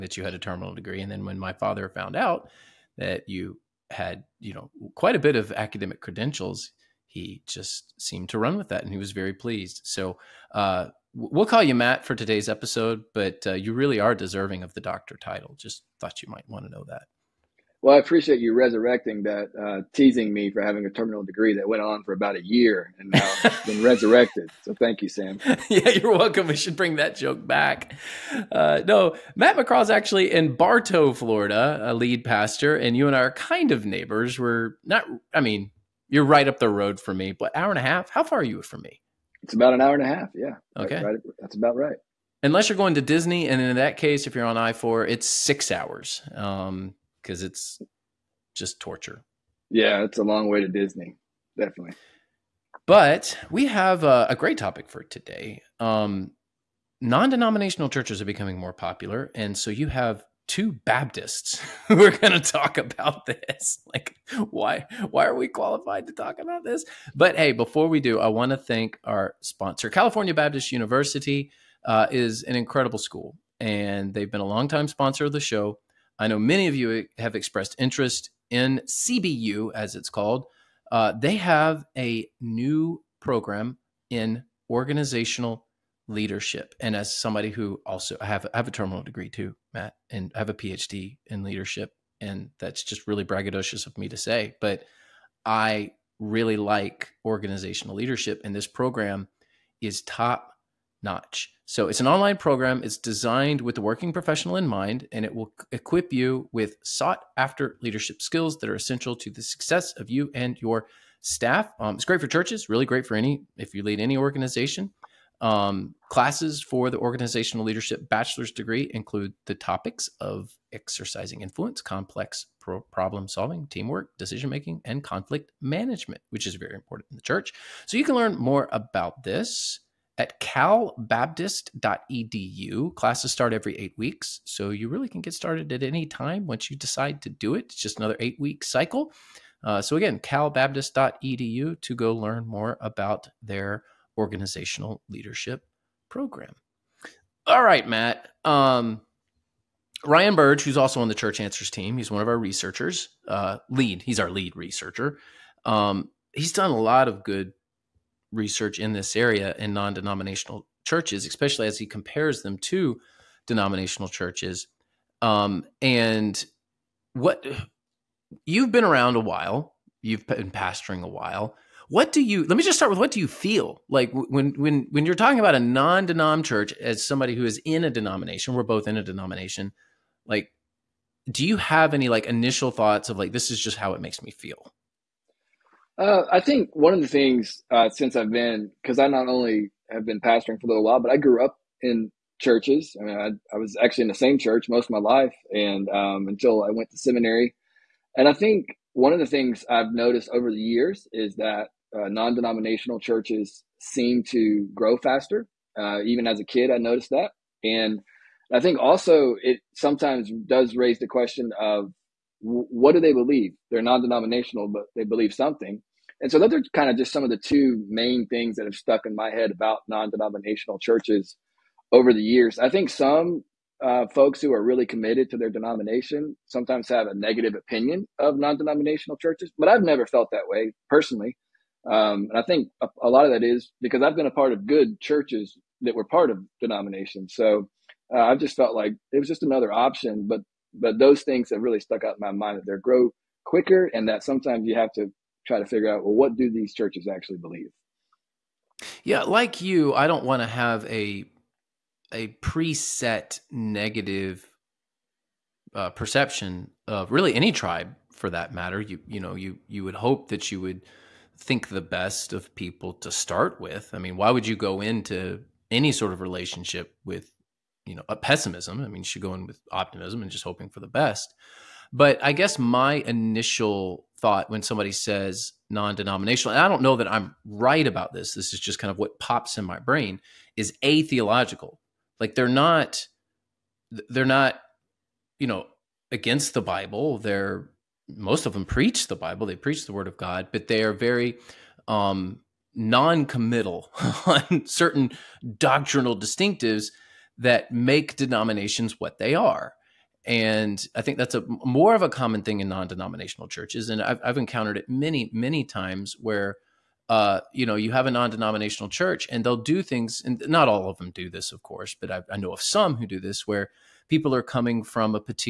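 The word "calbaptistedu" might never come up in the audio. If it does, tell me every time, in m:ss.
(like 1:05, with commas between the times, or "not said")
2:10, 2:20.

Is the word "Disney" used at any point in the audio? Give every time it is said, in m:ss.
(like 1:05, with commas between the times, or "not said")
0:43, 0:50.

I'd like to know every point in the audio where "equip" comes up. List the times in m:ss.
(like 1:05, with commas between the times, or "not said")
1:45.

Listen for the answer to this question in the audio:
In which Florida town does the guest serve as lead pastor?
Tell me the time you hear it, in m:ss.
0:30.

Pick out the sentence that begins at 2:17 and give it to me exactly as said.
It's just another eight week cycle.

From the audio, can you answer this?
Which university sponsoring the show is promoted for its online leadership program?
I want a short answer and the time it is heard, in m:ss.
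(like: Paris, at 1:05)
California Baptist University, at 1:09.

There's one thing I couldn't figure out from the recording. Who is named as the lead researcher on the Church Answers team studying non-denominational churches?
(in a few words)
Ryan Burge.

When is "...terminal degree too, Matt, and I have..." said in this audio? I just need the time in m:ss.
1:28.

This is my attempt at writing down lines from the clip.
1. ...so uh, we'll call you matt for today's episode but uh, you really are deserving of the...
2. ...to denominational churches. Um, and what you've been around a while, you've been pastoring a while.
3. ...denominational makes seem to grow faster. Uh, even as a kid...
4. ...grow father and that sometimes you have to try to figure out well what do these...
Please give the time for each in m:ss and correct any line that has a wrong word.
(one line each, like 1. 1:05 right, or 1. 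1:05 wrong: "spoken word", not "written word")
1. 0:09 right
2. 2:42 right
3. 3:22 wrong: "churches", not "makes"
4. 4:02 wrong: "quicker", not "father".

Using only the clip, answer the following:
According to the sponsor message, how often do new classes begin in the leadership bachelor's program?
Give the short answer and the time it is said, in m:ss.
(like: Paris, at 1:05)
every 8 weeks, at 2:13.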